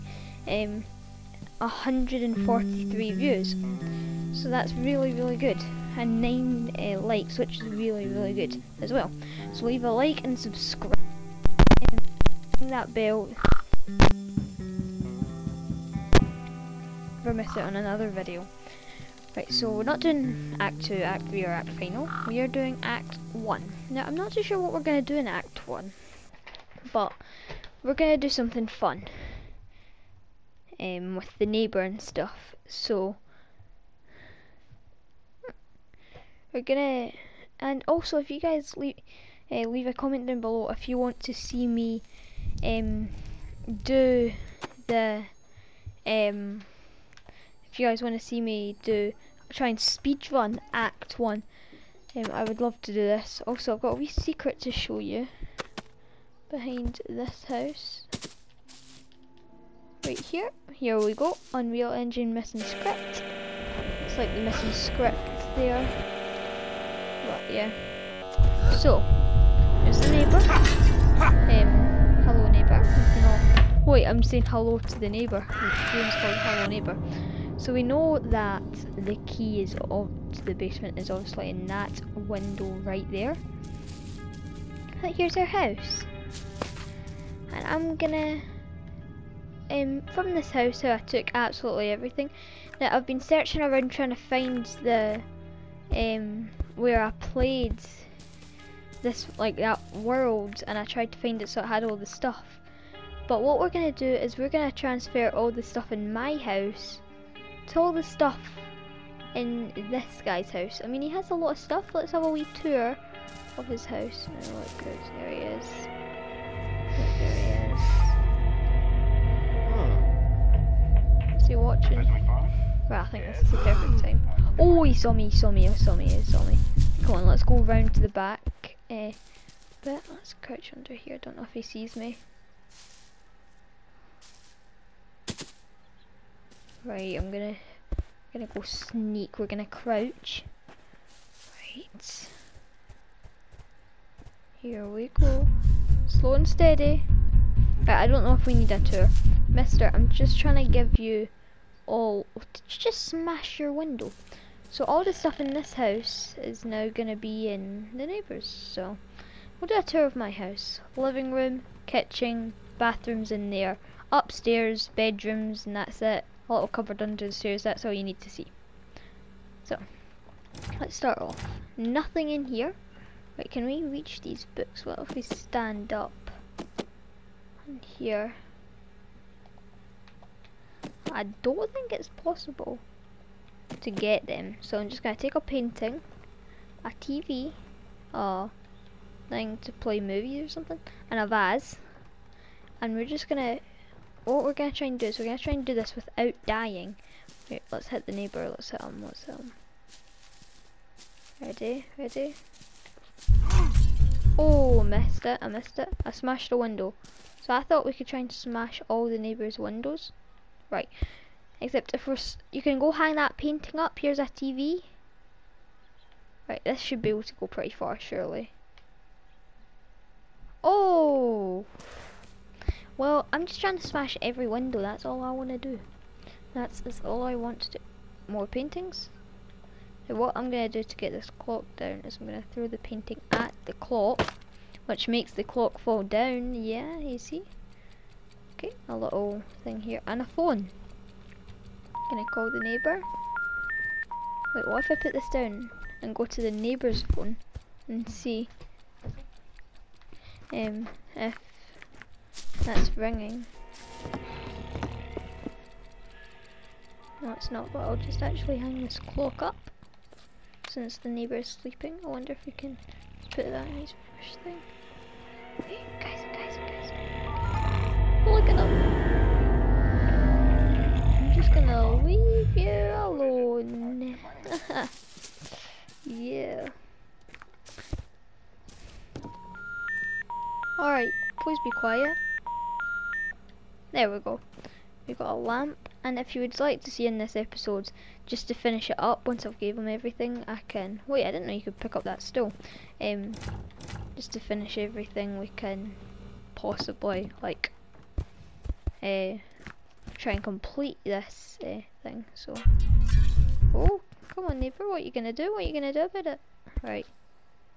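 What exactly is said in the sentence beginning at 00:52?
Um, I would love to do this.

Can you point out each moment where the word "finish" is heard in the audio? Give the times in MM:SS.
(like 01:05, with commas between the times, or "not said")
04:48, 04:54.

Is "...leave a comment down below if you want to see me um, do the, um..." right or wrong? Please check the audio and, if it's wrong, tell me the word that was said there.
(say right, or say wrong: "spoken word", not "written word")
right.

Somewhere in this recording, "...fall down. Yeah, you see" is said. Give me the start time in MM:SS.
03:55.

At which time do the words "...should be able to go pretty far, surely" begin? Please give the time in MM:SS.
03:36.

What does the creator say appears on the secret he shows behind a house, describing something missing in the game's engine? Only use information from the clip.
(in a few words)
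Unreal Engine missing script.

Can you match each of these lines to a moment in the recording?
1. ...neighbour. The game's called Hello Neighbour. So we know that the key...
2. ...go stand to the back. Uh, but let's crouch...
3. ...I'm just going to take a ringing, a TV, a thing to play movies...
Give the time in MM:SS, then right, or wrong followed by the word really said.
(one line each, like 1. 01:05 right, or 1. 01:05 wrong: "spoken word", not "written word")
1. 01:15 right
2. 02:07 wrong: "round", not "stand"
3. 03:04 wrong: "painting", not "ringing".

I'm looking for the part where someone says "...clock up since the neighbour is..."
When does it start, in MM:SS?
04:18.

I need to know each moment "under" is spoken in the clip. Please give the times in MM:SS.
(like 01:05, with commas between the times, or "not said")
02:10, 02:47.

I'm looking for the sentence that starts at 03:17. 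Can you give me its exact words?
Wait, let's hit the neighbour, let's hit him, let's hit him.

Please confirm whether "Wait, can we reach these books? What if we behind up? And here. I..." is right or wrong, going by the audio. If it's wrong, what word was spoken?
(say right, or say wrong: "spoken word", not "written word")
wrong: "stand", not "behind".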